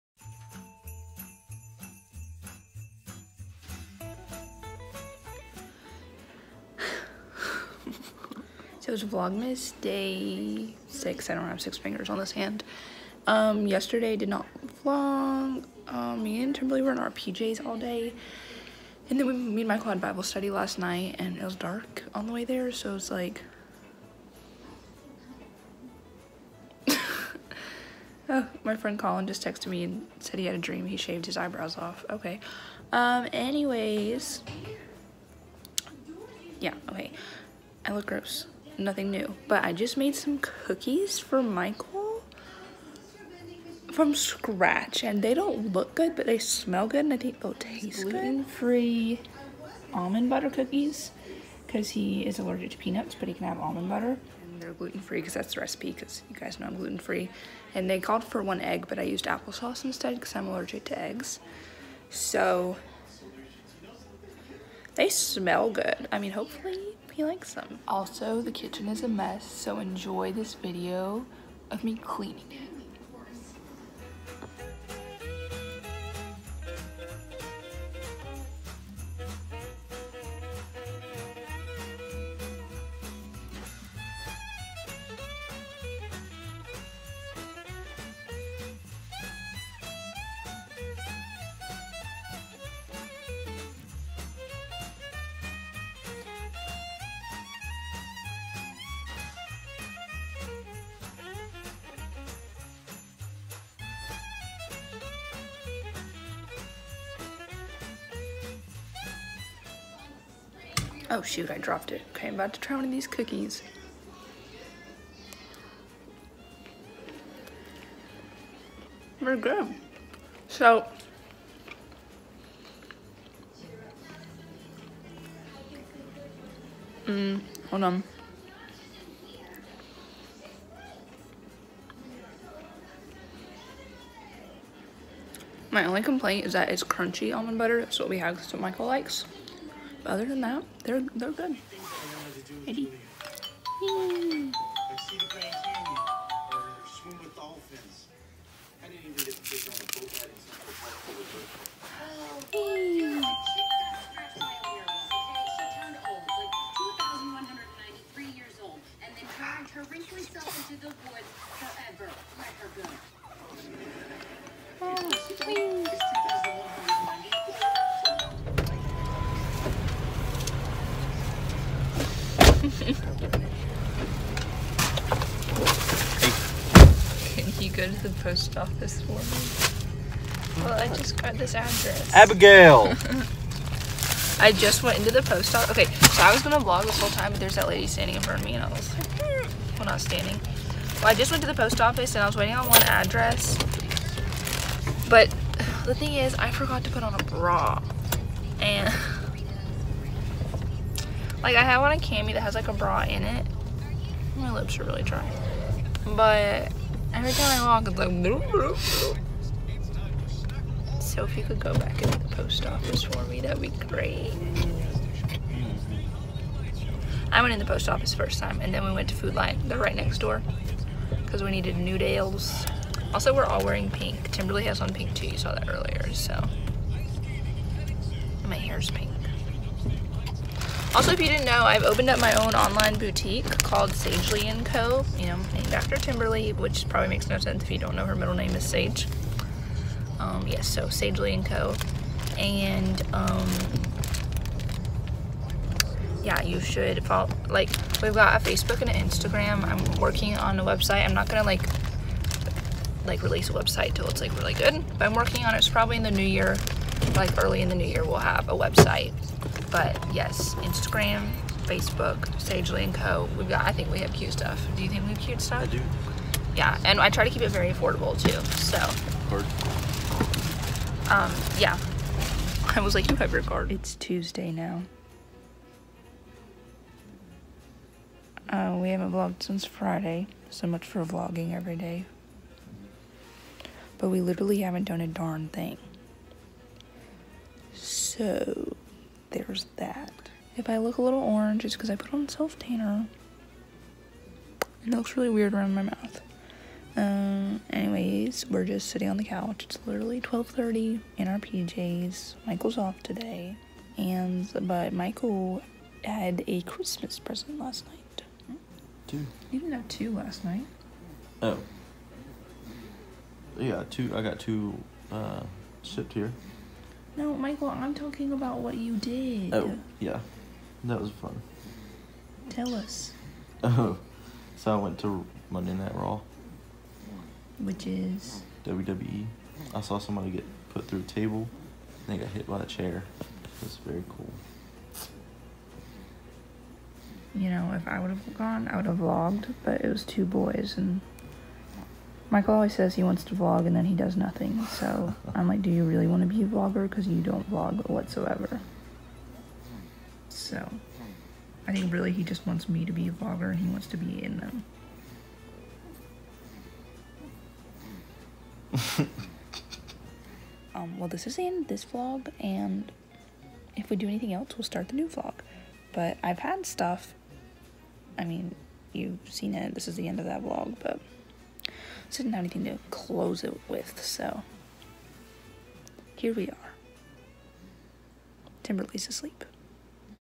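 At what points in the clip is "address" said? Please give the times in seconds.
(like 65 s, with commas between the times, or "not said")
181 s, 192 s.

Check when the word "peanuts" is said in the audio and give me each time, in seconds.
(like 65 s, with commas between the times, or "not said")
52 s.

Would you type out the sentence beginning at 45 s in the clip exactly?
And they don't look good, but they smell good.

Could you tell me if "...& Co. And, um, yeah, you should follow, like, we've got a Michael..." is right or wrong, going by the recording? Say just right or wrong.
wrong.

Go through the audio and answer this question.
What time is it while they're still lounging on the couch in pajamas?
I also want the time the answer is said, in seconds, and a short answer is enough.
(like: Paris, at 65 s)
12:30, at 300 s.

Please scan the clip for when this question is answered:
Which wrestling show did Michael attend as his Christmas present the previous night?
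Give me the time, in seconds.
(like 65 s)
325 s.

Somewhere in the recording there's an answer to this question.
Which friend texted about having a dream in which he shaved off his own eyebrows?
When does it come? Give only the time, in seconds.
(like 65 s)
28 s.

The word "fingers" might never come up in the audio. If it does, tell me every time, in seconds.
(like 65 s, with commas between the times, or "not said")
11 s.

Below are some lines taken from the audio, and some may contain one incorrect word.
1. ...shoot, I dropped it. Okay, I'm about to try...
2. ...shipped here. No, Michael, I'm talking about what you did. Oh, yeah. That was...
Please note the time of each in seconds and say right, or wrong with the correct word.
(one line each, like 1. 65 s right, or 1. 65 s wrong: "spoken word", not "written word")
1. 111 s right
2. 315 s right.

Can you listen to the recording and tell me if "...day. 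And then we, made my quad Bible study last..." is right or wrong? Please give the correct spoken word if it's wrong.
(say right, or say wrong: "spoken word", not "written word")
right.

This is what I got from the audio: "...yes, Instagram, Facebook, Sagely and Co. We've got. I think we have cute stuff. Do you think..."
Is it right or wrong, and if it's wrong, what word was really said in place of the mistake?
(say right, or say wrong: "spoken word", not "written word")
right.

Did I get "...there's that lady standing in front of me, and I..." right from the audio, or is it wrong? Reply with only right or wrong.
right.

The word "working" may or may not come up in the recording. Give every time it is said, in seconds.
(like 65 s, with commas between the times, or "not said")
250 s, 255 s.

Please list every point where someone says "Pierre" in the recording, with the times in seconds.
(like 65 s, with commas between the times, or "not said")
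not said.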